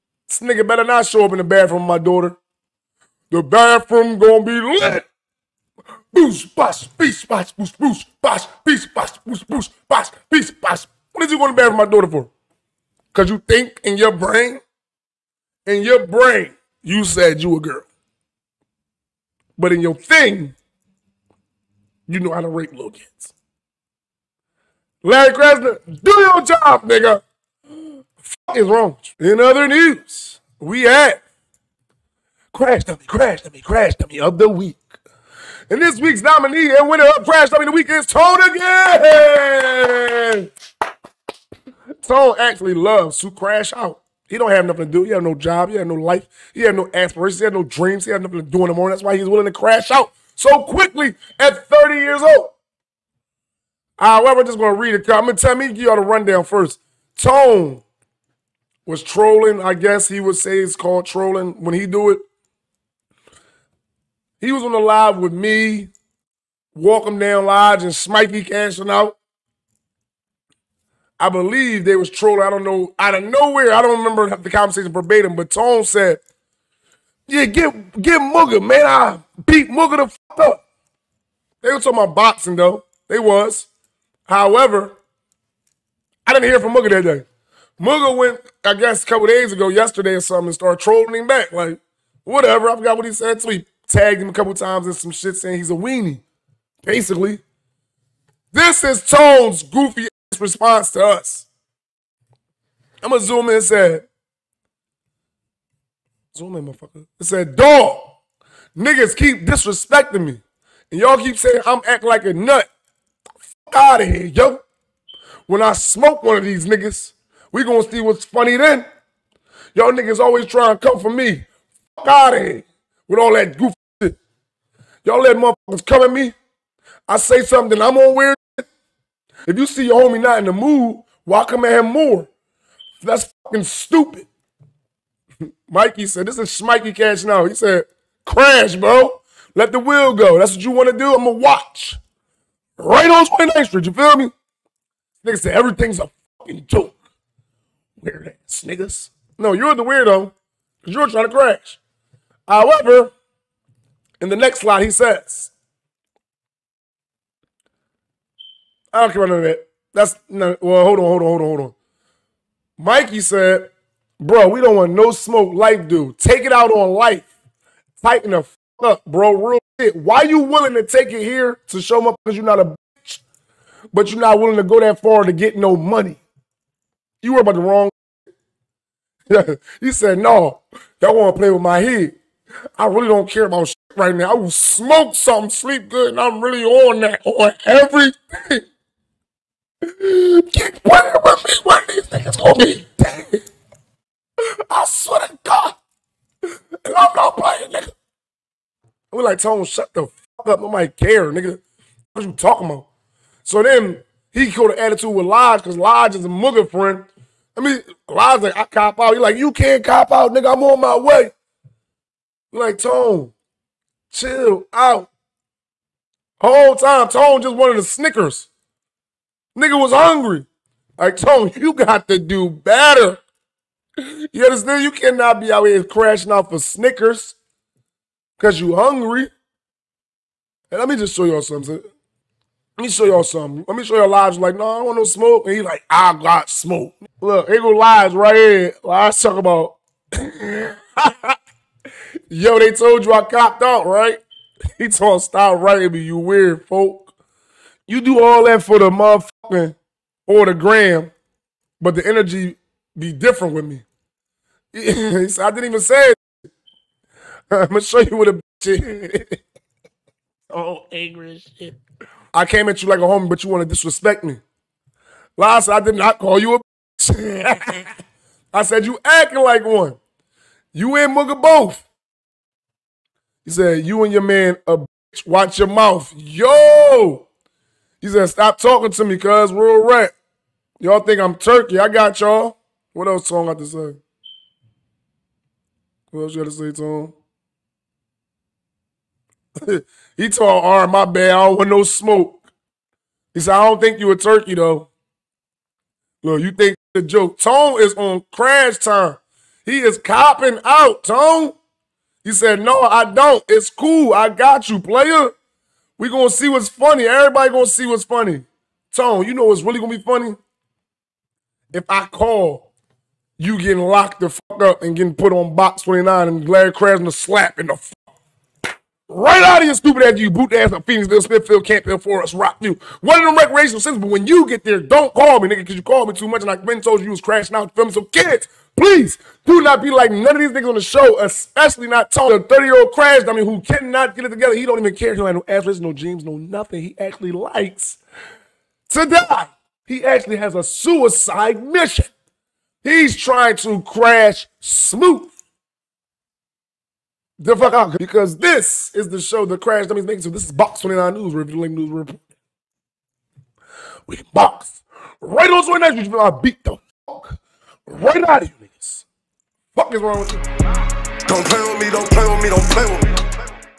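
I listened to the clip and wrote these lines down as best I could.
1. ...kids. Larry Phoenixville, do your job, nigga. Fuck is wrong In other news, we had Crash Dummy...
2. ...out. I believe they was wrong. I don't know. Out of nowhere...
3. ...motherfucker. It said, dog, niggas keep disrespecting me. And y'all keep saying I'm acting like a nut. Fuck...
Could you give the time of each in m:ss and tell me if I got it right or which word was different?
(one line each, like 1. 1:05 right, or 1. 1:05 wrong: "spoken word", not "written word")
1. 0:22 wrong: "Krasner", not "Phoenixville"
2. 1:08 wrong: "trolling", not "wrong"
3. 1:46 right.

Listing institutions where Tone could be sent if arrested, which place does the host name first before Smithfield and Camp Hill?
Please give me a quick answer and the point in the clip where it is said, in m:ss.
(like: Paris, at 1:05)
Phoenixville, at 5:20.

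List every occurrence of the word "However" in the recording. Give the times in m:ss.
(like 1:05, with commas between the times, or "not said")
0:53, 1:24, 2:32.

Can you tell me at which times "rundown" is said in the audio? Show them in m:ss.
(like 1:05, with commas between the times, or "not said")
0:56.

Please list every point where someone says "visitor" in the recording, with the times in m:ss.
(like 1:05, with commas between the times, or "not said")
not said.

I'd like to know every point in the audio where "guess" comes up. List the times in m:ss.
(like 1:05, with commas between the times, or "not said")
0:59, 1:28.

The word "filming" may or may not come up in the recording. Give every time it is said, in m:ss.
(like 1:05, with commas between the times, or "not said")
5:27.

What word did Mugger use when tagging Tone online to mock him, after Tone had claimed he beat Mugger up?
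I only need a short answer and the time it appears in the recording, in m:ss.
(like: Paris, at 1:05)
weenie, at 1:35.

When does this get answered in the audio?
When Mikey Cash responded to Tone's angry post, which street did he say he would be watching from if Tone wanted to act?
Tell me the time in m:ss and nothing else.
2:23.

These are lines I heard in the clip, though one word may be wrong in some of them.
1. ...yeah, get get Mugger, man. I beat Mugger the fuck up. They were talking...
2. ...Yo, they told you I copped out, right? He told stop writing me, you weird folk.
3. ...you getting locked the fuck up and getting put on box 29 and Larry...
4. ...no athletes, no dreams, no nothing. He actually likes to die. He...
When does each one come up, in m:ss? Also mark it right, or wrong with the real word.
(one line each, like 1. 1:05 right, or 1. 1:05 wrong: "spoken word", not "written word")
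1. 1:17 right
2. 4:02 right
3. 5:13 right
4. 5:35 right.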